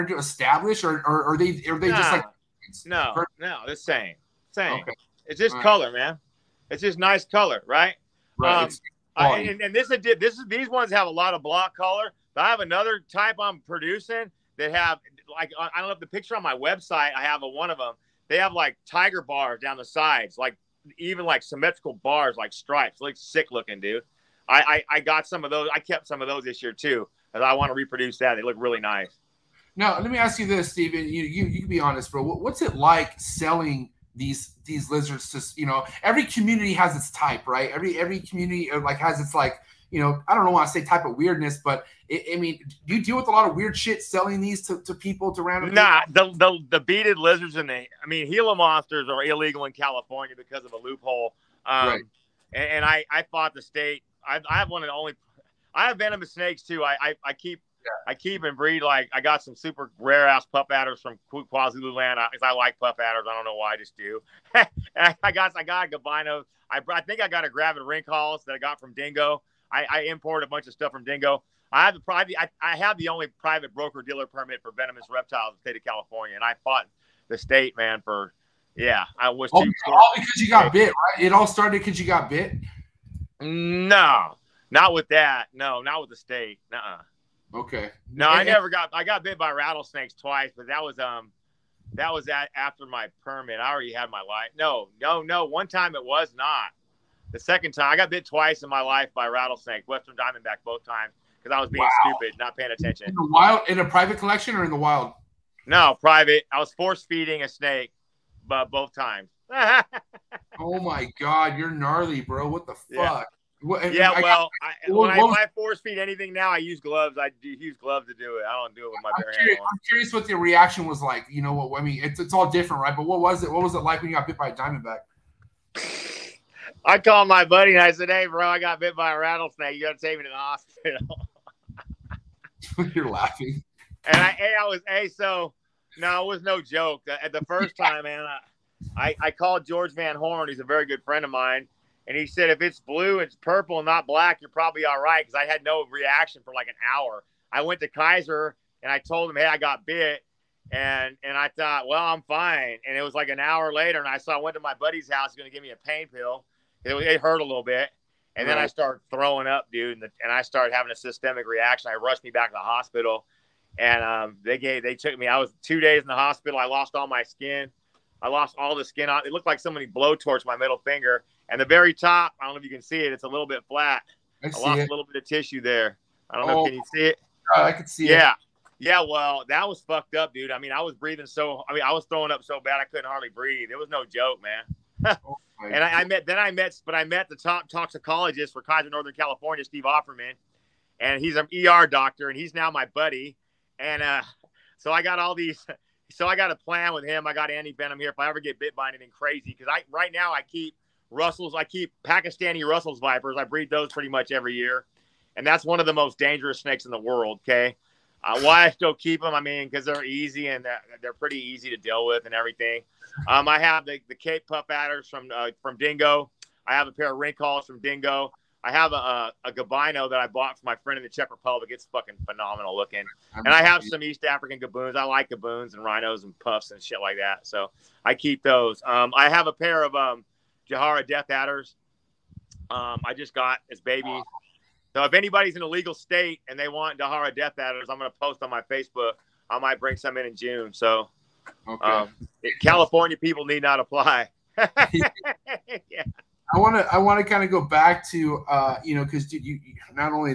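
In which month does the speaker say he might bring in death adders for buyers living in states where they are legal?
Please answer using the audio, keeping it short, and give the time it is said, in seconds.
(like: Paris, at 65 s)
June, at 240 s.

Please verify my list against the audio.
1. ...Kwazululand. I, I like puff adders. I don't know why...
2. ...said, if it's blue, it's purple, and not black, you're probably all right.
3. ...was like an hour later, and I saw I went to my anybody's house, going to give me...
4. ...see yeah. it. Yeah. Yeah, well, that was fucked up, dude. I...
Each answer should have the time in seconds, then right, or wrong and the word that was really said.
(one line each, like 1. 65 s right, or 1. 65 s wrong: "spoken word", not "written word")
1. 61 s right
2. 142 s right
3. 153 s wrong: "buddy", not "anybody"
4. 177 s right.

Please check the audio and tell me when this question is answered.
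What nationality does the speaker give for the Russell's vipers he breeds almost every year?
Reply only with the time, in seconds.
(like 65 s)
202 s.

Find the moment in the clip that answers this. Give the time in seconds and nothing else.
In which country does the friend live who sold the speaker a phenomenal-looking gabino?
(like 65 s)
221 s.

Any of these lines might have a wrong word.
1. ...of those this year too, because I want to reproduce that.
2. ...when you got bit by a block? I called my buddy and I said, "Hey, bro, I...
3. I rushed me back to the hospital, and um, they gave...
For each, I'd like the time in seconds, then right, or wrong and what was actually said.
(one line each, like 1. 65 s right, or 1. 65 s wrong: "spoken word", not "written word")
1. 26 s right
2. 124 s wrong: "diamondback", not "block"
3. 161 s right.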